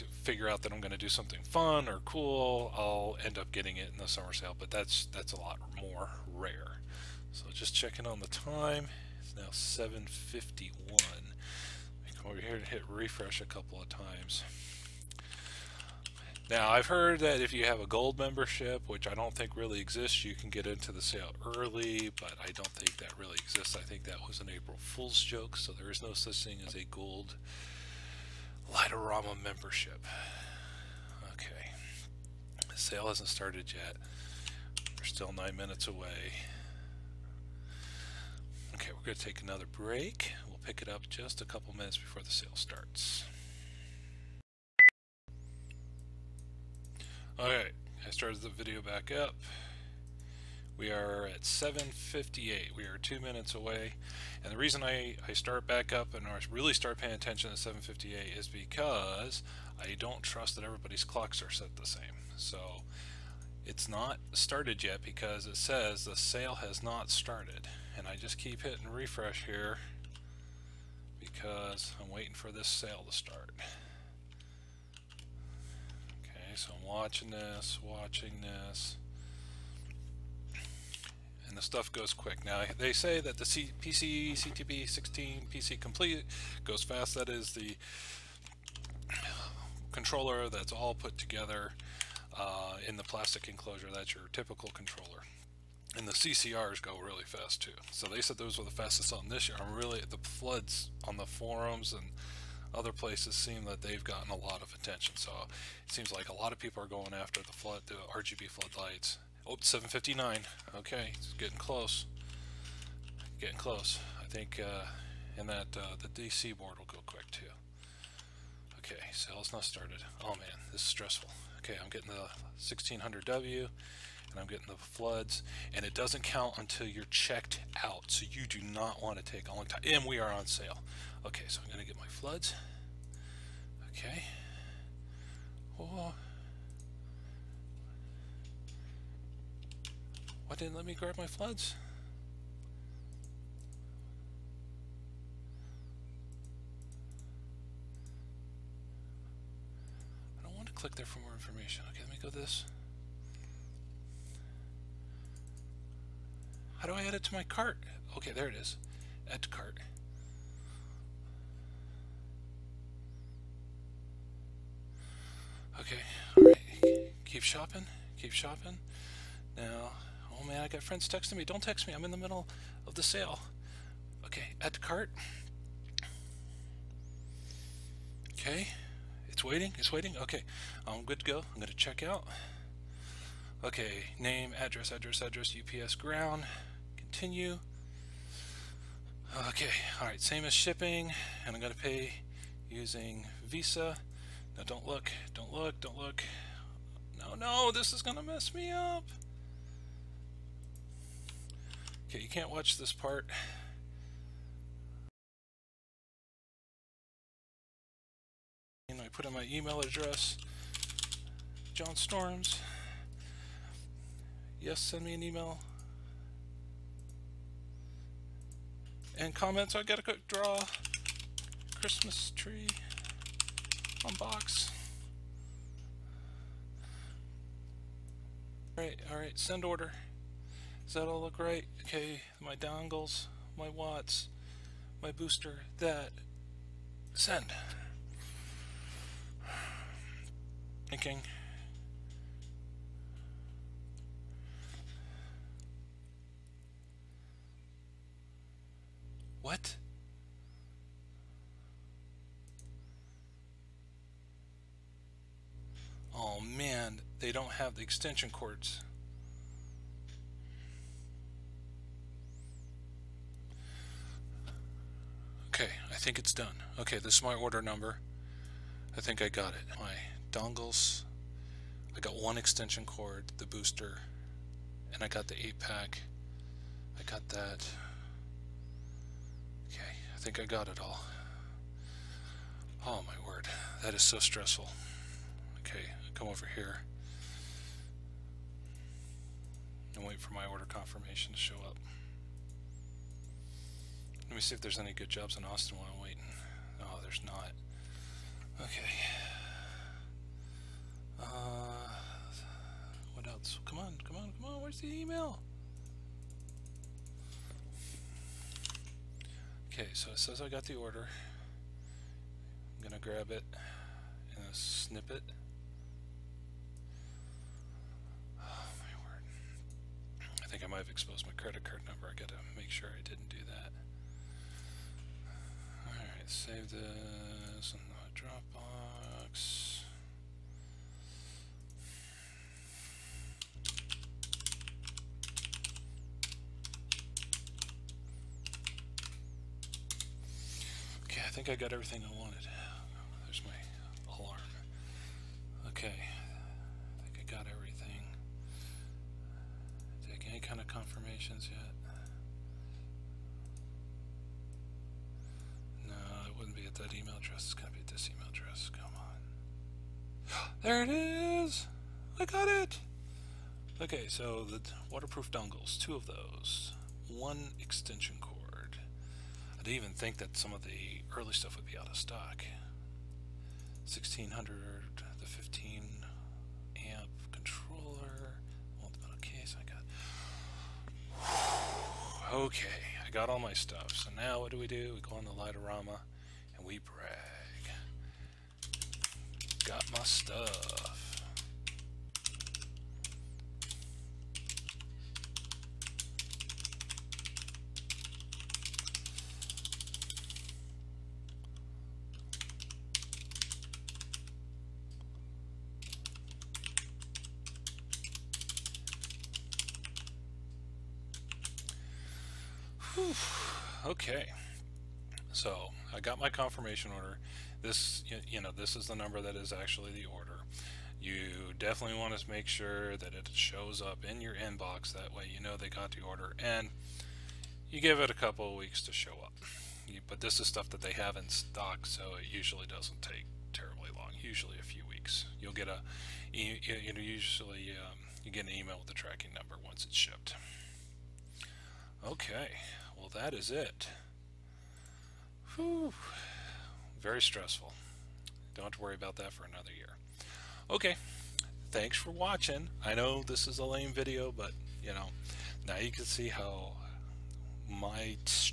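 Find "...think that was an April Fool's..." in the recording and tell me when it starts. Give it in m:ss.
0:23.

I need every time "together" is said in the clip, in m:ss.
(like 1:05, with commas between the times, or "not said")
1:31.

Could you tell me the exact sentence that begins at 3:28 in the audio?
And I put in my email address, John Storms.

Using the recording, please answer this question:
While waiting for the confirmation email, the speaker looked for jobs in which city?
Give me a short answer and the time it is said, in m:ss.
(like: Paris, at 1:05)
Austin, at 4:55.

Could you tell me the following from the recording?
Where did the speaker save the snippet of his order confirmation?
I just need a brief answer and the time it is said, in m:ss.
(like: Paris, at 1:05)
Dropbox, at 5:28.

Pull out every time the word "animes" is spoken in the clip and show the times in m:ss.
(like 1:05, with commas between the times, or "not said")
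not said.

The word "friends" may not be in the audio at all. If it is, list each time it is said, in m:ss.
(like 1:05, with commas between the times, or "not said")
2:50.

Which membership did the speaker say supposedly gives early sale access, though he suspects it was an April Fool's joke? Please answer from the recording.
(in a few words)
gold membership.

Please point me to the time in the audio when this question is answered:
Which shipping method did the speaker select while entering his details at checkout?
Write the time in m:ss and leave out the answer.
3:05.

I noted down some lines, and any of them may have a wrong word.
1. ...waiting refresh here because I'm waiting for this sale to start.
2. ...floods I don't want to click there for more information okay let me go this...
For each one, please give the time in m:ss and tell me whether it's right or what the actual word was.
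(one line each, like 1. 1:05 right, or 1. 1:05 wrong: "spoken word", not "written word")
1. 1:08 wrong: "hitting", not "waiting"
2. 2:21 right.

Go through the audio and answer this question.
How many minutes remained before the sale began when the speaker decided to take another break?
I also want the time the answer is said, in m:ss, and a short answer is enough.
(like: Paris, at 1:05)
9, at 0:35.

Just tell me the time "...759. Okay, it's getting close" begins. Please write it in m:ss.
1:49.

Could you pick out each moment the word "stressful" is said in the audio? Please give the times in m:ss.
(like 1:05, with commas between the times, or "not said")
2:00, 4:44, 7:27.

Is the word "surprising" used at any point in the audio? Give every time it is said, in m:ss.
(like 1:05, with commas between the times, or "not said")
not said.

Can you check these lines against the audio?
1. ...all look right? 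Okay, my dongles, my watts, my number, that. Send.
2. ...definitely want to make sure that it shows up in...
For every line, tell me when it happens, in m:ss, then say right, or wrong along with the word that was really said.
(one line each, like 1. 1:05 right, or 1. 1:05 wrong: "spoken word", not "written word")
1. 3:51 wrong: "booster", not "number"
2. 7:01 right.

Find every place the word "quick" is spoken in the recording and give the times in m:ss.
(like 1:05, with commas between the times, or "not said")
1:22, 1:57, 3:40.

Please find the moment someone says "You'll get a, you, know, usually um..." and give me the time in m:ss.
7:15.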